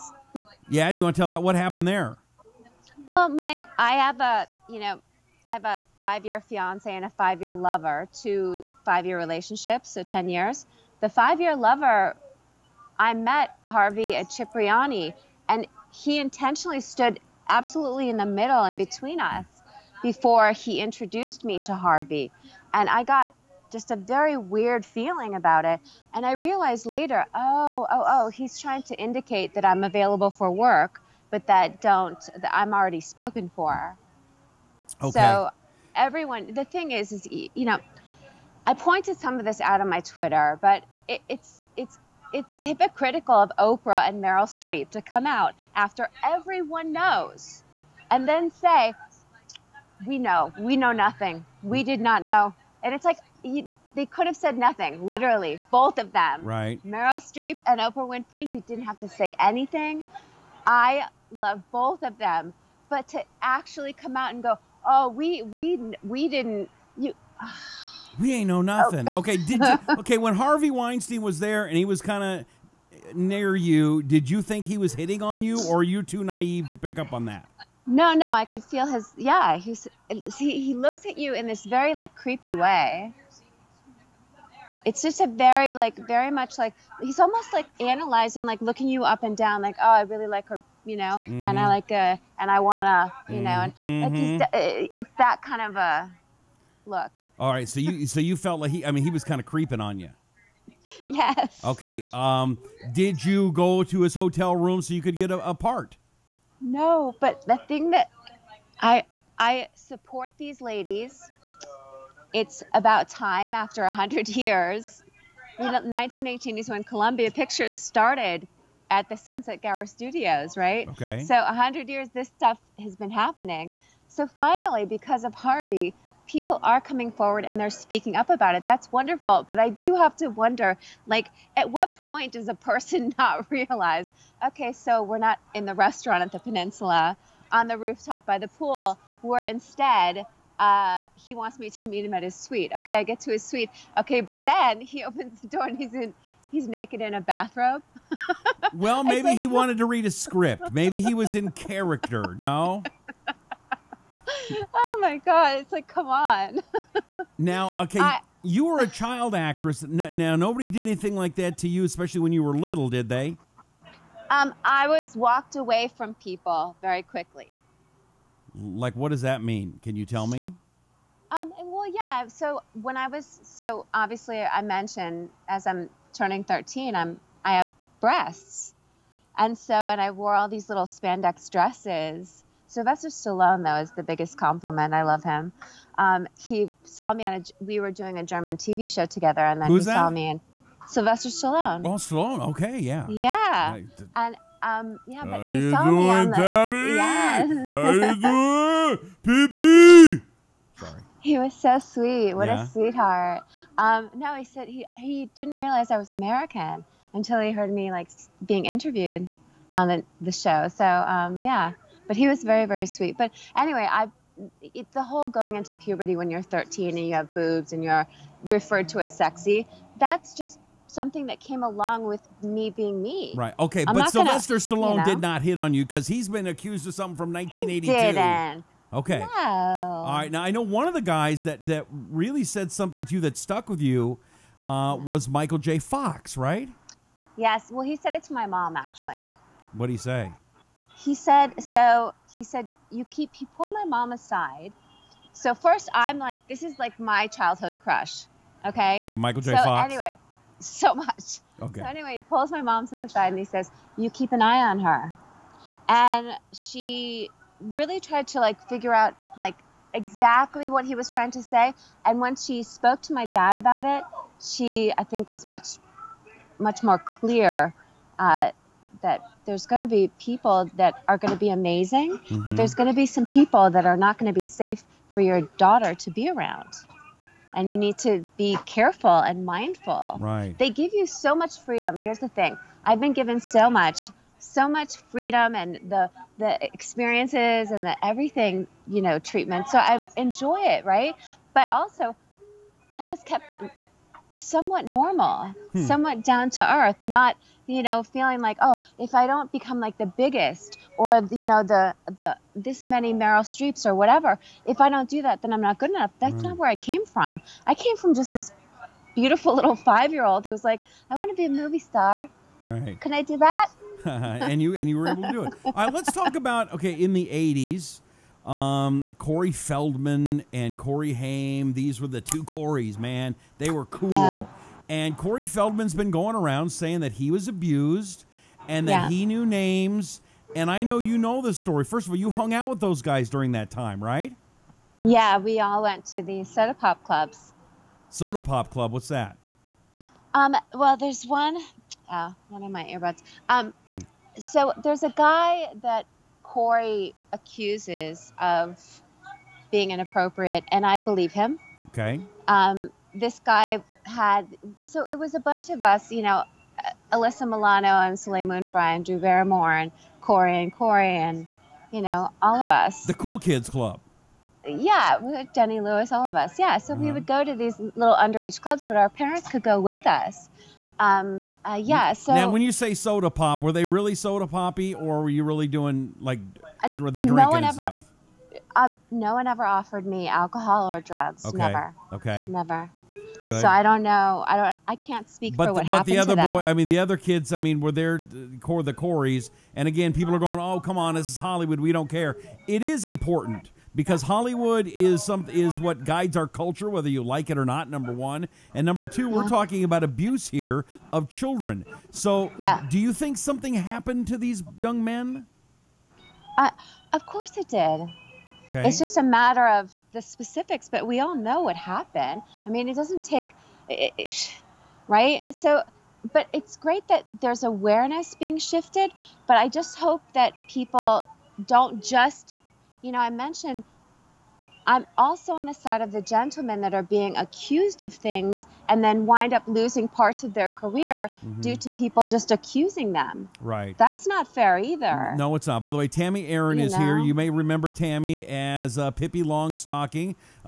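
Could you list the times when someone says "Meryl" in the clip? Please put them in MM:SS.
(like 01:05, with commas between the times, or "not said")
00:44, 00:56, 05:03.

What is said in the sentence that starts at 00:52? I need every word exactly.
And it's like, you, they could have said nothing, literally, both of them.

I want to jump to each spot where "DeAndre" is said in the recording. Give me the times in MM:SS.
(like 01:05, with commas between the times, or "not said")
not said.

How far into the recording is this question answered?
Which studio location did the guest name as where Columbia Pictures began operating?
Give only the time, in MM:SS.
01:59.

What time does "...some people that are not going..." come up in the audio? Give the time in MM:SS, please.
04:33.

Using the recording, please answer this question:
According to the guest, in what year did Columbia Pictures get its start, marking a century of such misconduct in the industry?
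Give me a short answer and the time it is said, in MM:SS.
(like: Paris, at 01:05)
1918, at 01:55.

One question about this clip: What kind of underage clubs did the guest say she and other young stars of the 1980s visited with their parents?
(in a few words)
soda pop clubs.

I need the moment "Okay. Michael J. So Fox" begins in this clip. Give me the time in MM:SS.
04:08.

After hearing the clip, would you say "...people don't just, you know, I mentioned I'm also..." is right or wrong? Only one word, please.
right.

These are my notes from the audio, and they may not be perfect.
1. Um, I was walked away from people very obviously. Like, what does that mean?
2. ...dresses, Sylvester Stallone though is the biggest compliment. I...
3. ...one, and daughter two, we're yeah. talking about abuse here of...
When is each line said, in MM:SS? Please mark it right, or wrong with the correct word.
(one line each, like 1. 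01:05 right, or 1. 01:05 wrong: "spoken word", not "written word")
1. 02:44 wrong: "quickly", not "obviously"
2. 03:01 right
3. 06:38 wrong: "number", not "daughter".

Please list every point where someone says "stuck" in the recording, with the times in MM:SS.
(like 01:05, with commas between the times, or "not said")
03:53.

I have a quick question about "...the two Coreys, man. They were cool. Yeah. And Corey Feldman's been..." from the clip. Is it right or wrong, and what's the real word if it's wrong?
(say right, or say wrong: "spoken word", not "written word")
right.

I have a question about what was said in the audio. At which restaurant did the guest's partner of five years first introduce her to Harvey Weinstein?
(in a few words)
Cipriani.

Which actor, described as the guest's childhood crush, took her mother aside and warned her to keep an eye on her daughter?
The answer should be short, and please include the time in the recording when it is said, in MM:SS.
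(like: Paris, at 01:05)
Michael J. Fox, at 03:55.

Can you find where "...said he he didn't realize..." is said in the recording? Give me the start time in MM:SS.
03:24.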